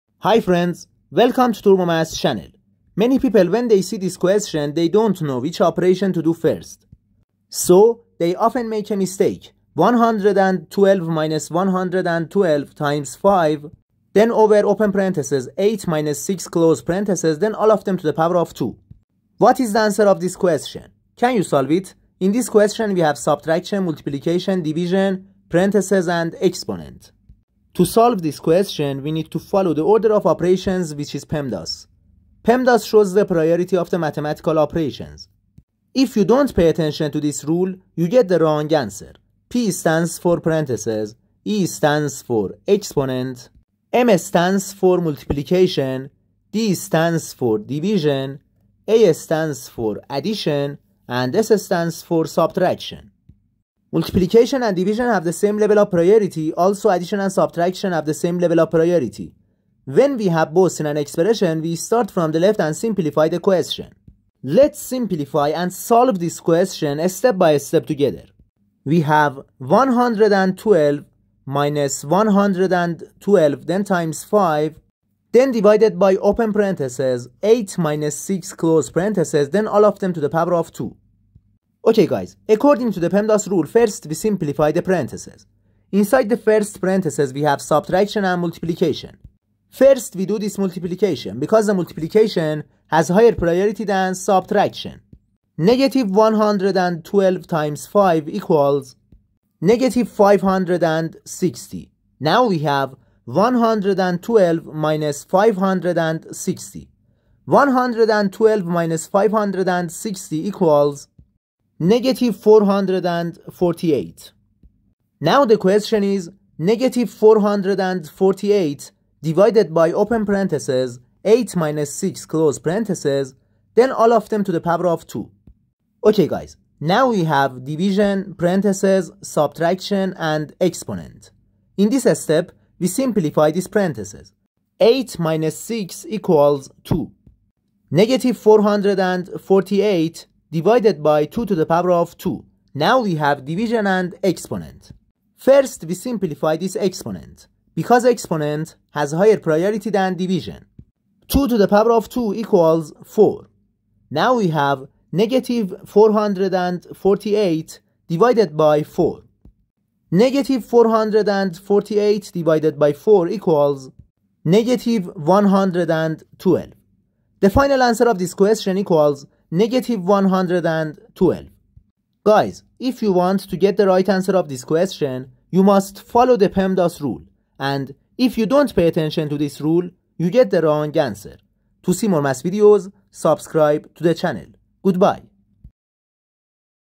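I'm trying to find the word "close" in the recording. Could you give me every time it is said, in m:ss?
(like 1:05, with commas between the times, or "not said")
0:16, 1:18, 2:02.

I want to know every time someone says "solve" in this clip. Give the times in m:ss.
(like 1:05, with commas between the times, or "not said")
0:21, 0:27, 1:05.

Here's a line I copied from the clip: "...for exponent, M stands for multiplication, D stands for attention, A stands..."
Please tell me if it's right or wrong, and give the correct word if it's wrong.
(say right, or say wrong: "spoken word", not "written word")
wrong: "division", not "attention".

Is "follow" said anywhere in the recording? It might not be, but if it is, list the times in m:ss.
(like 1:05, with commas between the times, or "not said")
0:29, 2:56.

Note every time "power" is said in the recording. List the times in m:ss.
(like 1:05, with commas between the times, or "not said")
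0:18, 1:20, 2:04, 2:21, 2:31.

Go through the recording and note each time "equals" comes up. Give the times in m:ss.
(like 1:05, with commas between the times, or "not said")
1:38, 1:50, 2:16, 2:32, 2:43, 2:48.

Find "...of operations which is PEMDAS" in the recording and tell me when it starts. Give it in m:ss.
0:30.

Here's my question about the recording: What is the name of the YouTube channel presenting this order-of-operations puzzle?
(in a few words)
TurboMath.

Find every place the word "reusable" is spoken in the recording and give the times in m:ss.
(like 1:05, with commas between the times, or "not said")
not said.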